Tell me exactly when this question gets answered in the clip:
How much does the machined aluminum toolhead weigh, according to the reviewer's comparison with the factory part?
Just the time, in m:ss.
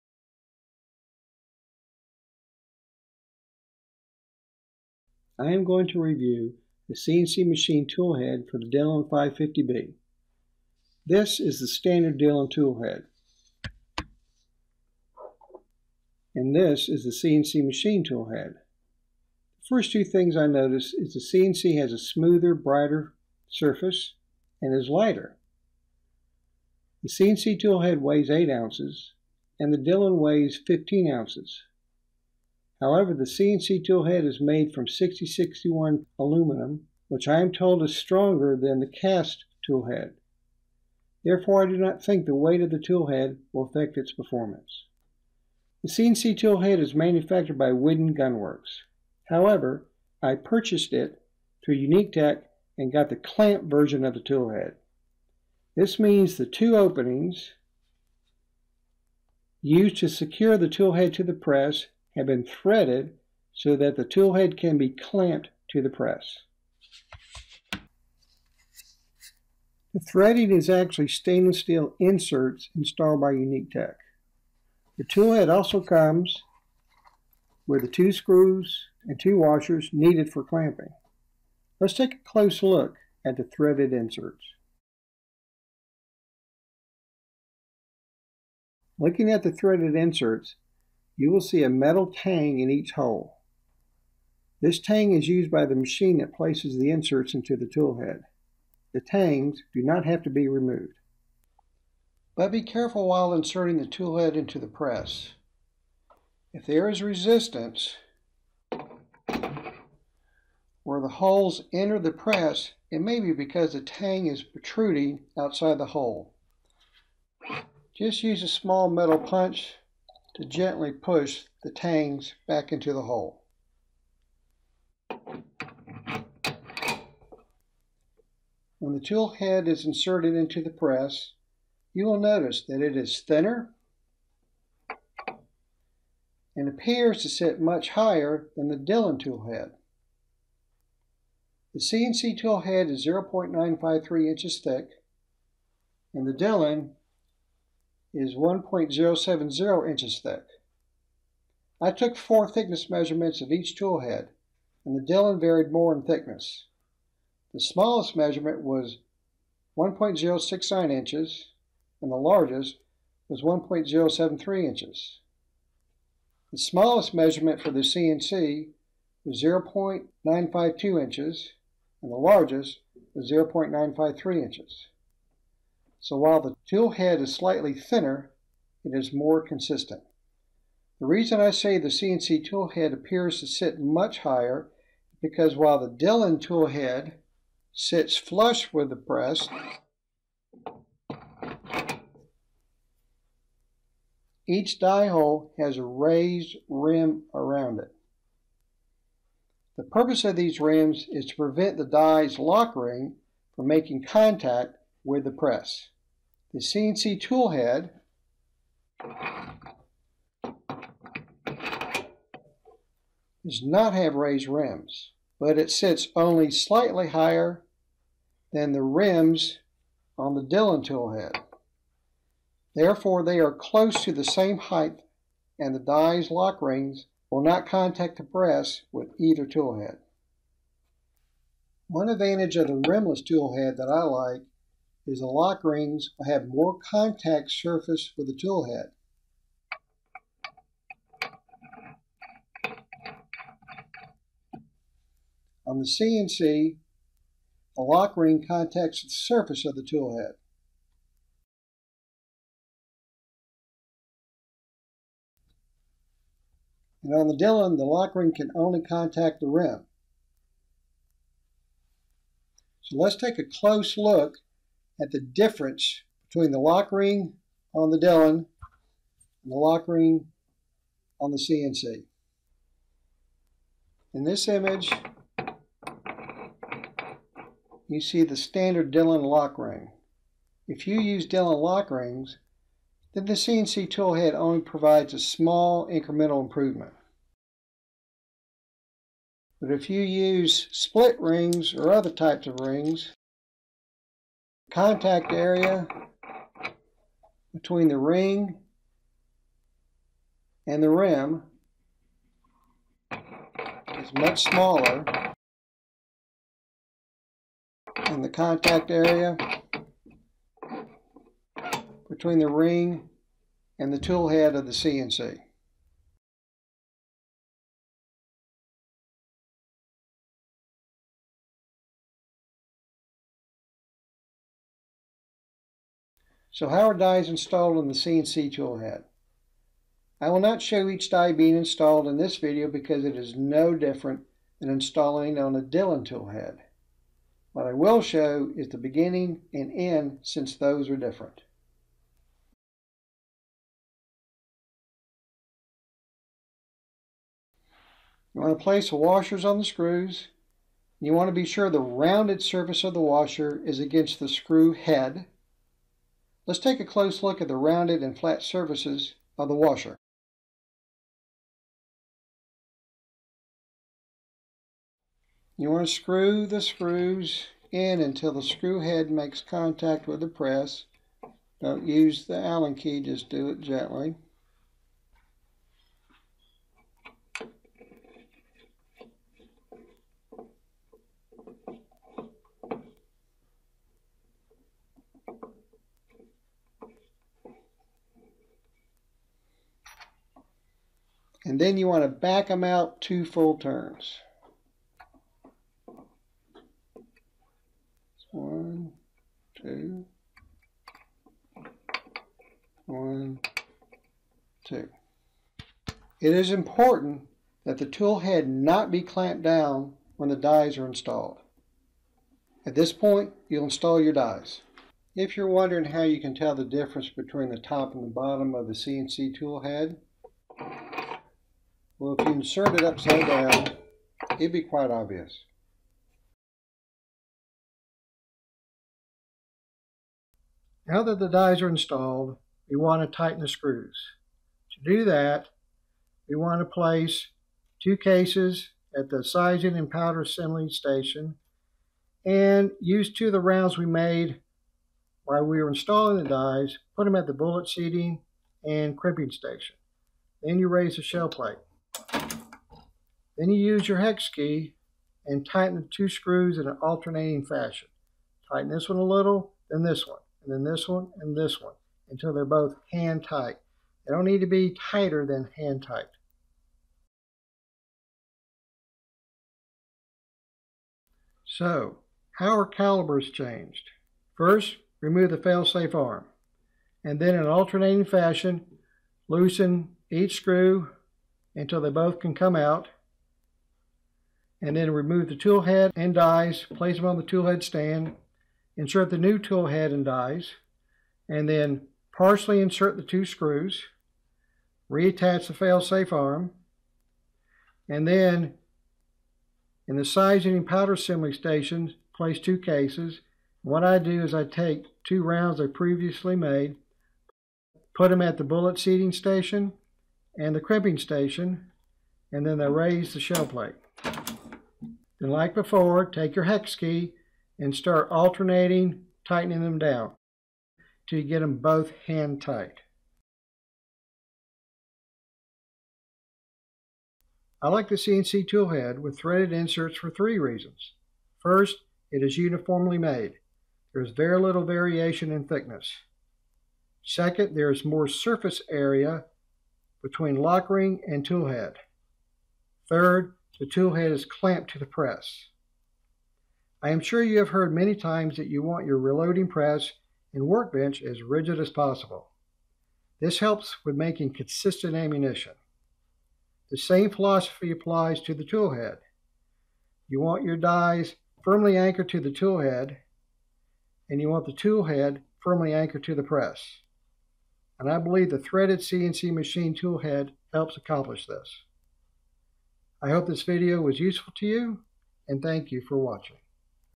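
0:28.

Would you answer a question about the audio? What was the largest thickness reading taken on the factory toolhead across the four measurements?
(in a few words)
1.073 inches.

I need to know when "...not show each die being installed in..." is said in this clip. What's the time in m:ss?
5:30.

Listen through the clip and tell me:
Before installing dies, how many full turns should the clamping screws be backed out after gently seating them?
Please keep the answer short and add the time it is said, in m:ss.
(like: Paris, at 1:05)
2, at 6:33.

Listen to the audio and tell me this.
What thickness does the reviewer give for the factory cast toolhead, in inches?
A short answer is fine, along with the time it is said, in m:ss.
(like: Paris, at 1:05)
1.070 inches, at 2:28.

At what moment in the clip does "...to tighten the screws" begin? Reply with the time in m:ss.
7:13.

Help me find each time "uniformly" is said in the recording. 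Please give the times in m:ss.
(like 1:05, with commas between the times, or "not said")
8:52.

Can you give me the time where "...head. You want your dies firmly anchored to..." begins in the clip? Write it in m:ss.
9:18.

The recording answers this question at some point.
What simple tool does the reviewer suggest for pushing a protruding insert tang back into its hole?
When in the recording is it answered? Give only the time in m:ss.
1:58.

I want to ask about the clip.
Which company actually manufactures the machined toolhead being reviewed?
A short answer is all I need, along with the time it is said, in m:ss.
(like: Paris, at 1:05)
Whidden Gunworks, at 0:47.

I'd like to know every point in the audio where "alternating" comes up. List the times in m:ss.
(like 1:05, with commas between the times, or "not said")
7:36, 7:57, 8:38.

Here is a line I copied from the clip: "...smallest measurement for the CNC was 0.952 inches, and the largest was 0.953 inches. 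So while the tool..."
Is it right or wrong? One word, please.
right.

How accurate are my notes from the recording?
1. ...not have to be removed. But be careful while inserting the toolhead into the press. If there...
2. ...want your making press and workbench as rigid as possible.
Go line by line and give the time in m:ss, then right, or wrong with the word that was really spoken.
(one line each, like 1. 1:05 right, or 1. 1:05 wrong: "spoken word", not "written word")
1. 1:39 right
2. 9:08 wrong: "reloading", not "making".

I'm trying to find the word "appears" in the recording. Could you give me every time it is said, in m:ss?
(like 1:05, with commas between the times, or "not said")
2:16, 3:02.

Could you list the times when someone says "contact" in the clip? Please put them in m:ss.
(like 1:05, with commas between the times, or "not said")
3:24, 3:47, 3:56, 4:08, 4:18, 4:54, 5:08, 6:09.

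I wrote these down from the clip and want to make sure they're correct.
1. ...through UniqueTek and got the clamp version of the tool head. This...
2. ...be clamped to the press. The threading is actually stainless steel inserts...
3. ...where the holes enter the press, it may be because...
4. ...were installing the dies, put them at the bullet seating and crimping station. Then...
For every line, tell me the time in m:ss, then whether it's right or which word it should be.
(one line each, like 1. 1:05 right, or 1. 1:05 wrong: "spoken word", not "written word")
1. 0:51 right
2. 1:04 right
3. 1:50 right
4. 7:25 right.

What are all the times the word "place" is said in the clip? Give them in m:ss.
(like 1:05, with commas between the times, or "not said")
1:36, 5:48, 7:16, 8:06, 8:22.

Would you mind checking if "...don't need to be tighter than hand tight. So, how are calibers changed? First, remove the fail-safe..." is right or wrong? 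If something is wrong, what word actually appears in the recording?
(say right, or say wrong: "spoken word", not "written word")
right.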